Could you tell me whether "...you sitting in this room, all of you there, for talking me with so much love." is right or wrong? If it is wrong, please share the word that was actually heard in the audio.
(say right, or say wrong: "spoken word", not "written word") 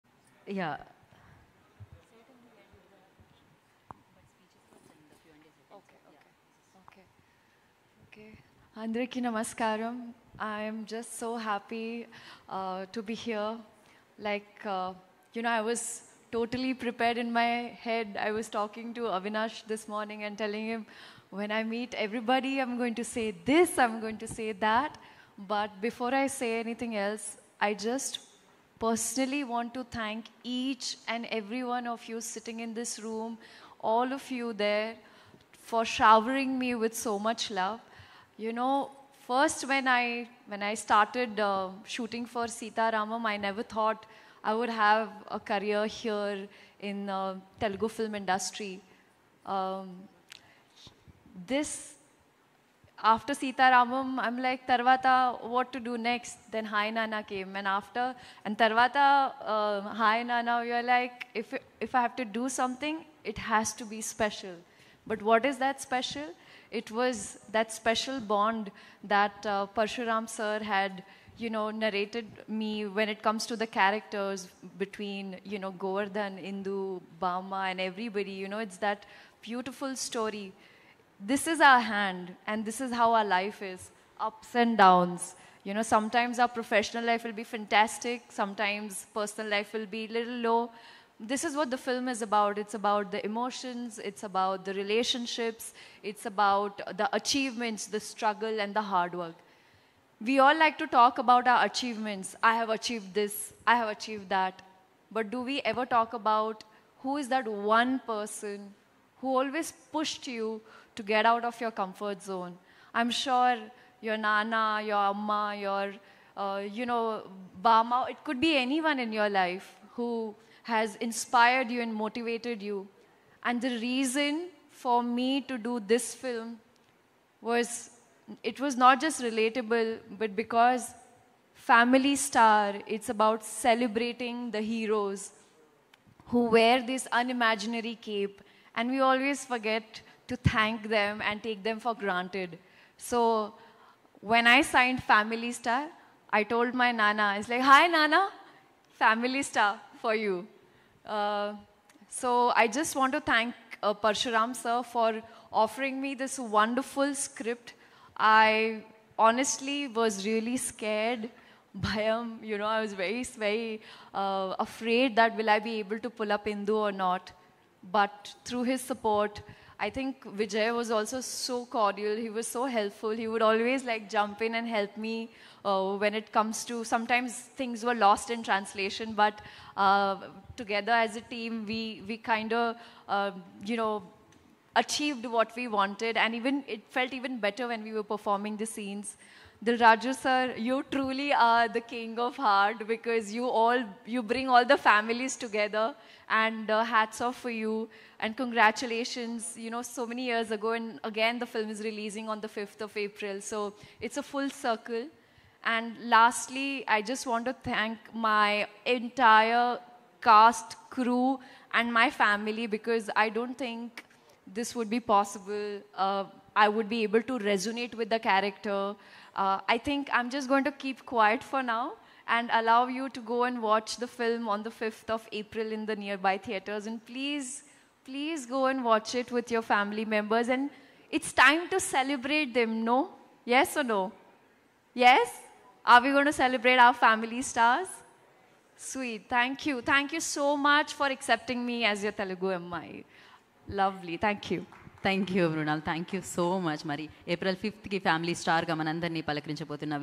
wrong: "showering", not "talking".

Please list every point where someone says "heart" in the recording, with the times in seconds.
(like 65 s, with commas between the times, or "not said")
192 s.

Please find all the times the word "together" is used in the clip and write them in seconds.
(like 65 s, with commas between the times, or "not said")
180 s, 195 s.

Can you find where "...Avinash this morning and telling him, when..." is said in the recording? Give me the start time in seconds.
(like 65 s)
19 s.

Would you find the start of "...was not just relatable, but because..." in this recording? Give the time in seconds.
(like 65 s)
128 s.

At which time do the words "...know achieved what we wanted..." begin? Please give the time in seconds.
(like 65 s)
183 s.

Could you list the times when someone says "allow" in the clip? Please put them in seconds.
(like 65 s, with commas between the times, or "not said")
222 s.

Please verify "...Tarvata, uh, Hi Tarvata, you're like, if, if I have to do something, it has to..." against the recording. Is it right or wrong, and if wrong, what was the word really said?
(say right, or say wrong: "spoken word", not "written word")
wrong: "Nana", not "Tarvata".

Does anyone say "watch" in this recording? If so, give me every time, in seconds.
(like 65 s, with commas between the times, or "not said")
223 s, 228 s.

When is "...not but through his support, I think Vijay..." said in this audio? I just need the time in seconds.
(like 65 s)
166 s.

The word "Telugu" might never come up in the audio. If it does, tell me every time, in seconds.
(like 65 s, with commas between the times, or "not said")
47 s, 242 s.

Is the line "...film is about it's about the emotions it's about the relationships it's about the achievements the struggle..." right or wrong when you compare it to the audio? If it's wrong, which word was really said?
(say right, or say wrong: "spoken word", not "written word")
right.